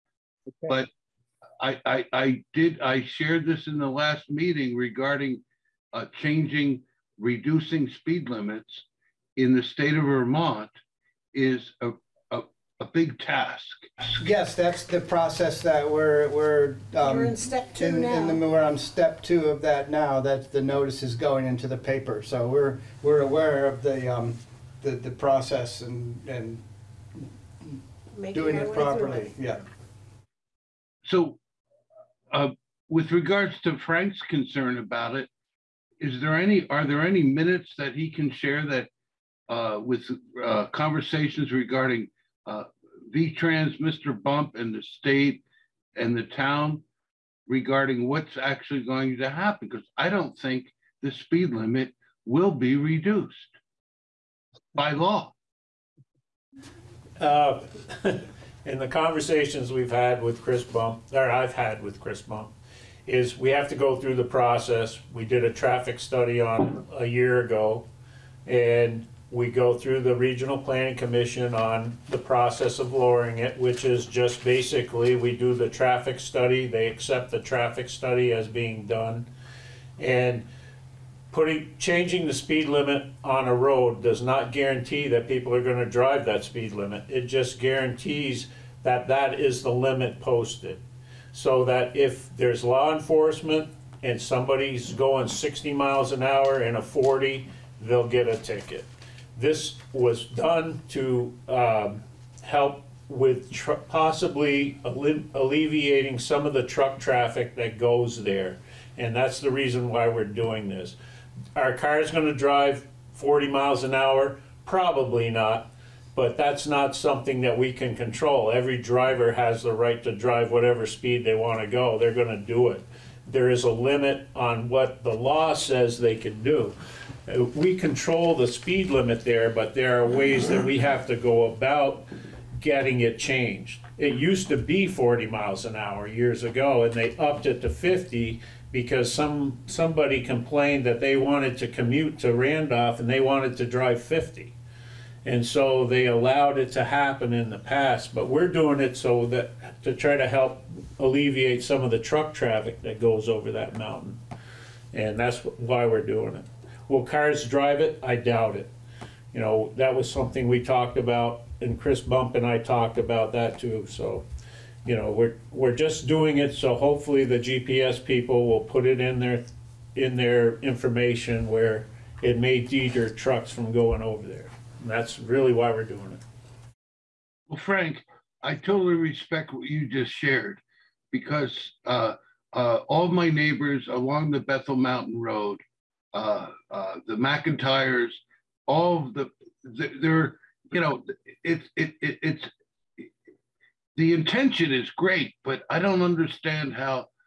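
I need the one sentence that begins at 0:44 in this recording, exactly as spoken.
Bump, and the state and the town regarding what's actually going to happen?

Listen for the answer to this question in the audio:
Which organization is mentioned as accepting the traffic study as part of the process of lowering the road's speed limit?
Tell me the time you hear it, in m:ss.
1:10.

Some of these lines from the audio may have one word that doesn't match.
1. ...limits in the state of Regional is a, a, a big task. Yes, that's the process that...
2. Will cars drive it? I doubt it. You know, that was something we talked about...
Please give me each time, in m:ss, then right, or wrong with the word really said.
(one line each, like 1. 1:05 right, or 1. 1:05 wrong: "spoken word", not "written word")
1. 0:08 wrong: "Vermont", not "Regional"
2. 2:36 right.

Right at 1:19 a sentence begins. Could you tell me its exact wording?
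And putting changing the speed limit on a road does not guarantee that people are going to drive that speed limit.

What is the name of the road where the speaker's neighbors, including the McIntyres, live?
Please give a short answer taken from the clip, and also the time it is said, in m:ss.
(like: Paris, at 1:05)
Bethel Mountain Road, at 3:04.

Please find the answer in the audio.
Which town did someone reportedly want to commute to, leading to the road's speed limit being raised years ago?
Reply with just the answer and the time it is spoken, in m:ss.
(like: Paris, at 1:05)
Randolph, at 2:22.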